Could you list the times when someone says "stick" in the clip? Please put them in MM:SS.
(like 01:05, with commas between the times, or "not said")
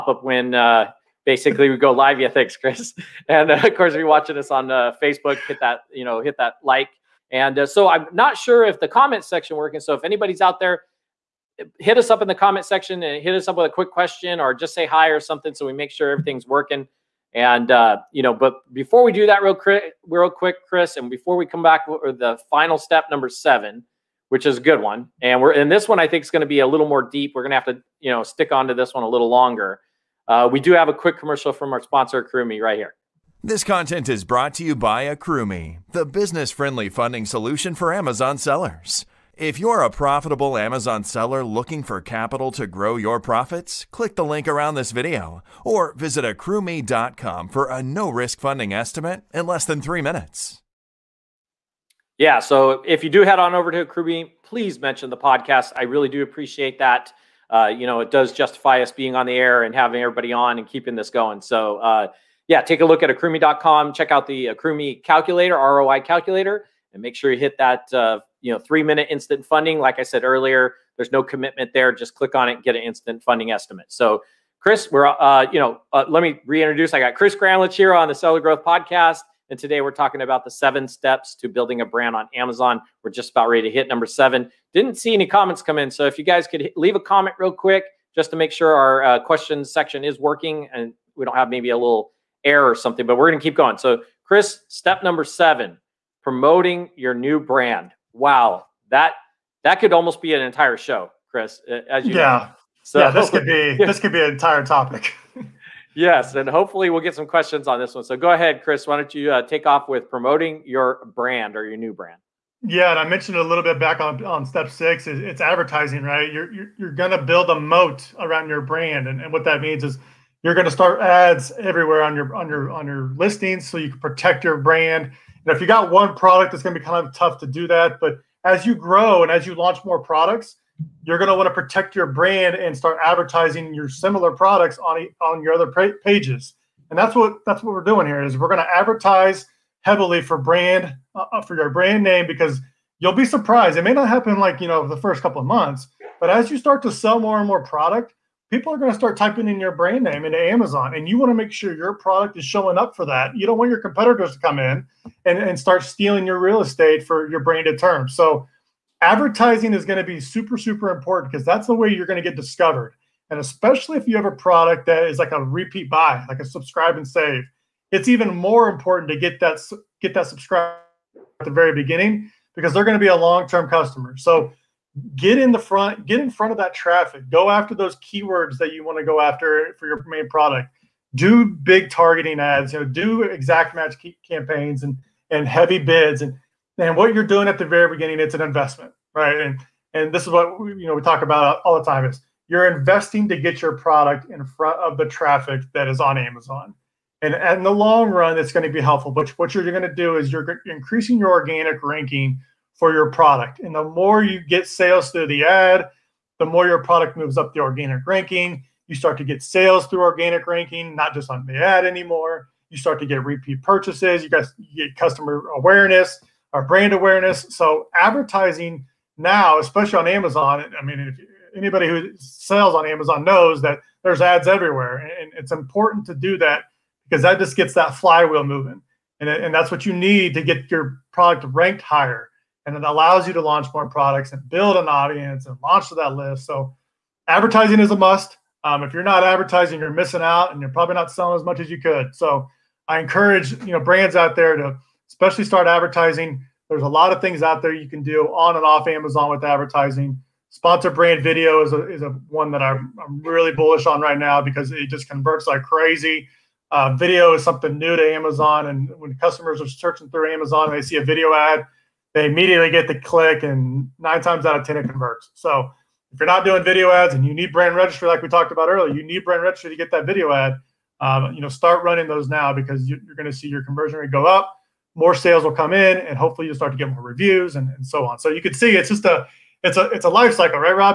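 00:28.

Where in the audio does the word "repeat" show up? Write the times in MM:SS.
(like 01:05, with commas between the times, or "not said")
02:45, 03:33.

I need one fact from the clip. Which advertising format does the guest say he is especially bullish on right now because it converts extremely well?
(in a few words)
Sponsor brand video.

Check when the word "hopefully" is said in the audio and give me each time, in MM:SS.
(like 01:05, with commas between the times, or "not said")
01:46, 04:36.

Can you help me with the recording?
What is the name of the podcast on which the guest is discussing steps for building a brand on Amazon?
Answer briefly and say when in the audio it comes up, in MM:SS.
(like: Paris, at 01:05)
Seller Growth Podcast, at 01:18.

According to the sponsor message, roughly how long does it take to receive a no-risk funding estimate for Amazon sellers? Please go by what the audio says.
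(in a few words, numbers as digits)
less than 3 minutes.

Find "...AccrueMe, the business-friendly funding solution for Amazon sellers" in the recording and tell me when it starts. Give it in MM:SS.
00:35.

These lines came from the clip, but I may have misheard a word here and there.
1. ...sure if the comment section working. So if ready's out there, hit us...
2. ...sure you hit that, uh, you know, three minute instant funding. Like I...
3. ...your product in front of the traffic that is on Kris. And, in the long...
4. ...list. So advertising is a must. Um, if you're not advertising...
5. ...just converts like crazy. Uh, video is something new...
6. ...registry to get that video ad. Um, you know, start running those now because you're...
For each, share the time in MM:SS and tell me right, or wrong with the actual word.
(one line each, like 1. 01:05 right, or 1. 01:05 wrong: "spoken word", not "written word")
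1. 00:08 wrong: "anybody", not "ready"
2. 01:07 right
3. 03:13 wrong: "Amazon", not "Kris"
4. 03:56 right
5. 04:14 right
6. 04:29 right.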